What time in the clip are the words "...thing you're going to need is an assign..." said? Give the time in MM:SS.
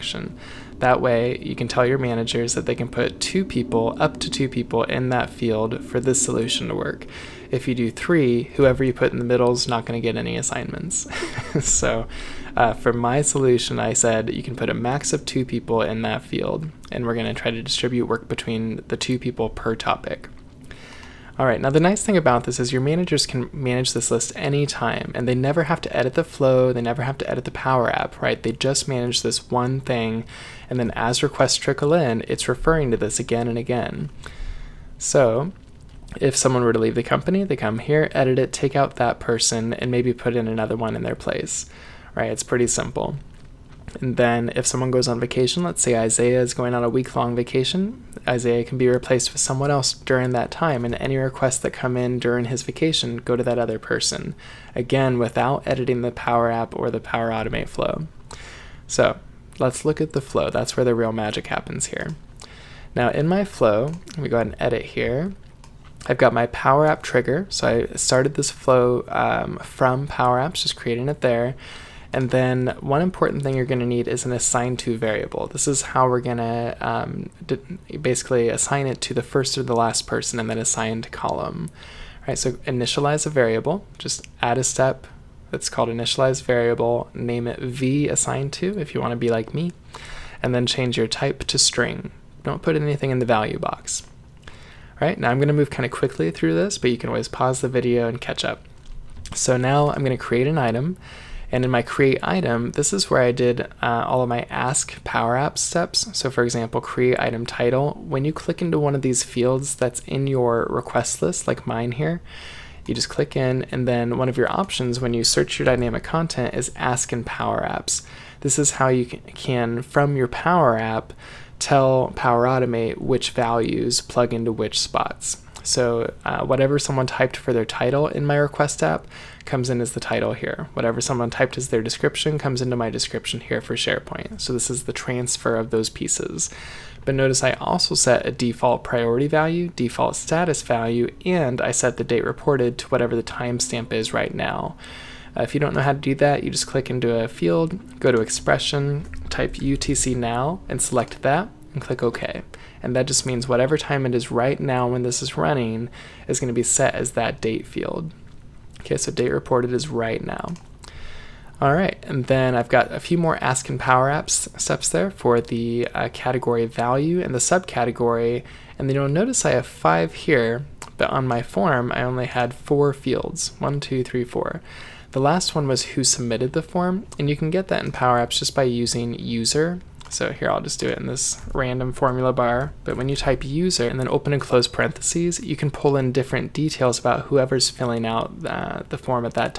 01:13.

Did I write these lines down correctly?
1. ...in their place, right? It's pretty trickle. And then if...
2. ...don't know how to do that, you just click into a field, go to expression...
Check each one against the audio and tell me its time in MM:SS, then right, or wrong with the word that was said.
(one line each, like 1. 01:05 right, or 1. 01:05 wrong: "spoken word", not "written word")
1. 00:40 wrong: "simple", not "trickle"
2. 02:25 right.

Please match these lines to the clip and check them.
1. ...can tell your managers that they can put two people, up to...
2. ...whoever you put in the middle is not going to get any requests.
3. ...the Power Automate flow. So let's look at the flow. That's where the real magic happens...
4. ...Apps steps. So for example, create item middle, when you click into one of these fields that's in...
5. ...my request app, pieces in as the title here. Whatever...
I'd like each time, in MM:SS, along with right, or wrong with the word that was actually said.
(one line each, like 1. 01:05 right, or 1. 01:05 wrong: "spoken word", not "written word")
1. 00:01 right
2. 00:08 wrong: "assignments", not "requests"
3. 00:56 right
4. 01:45 wrong: "title", not "middle"
5. 02:08 wrong: "comes", not "pieces".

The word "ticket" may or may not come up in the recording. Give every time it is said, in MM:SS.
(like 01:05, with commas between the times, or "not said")
not said.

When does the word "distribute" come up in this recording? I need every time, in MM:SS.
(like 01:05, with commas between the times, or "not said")
00:17.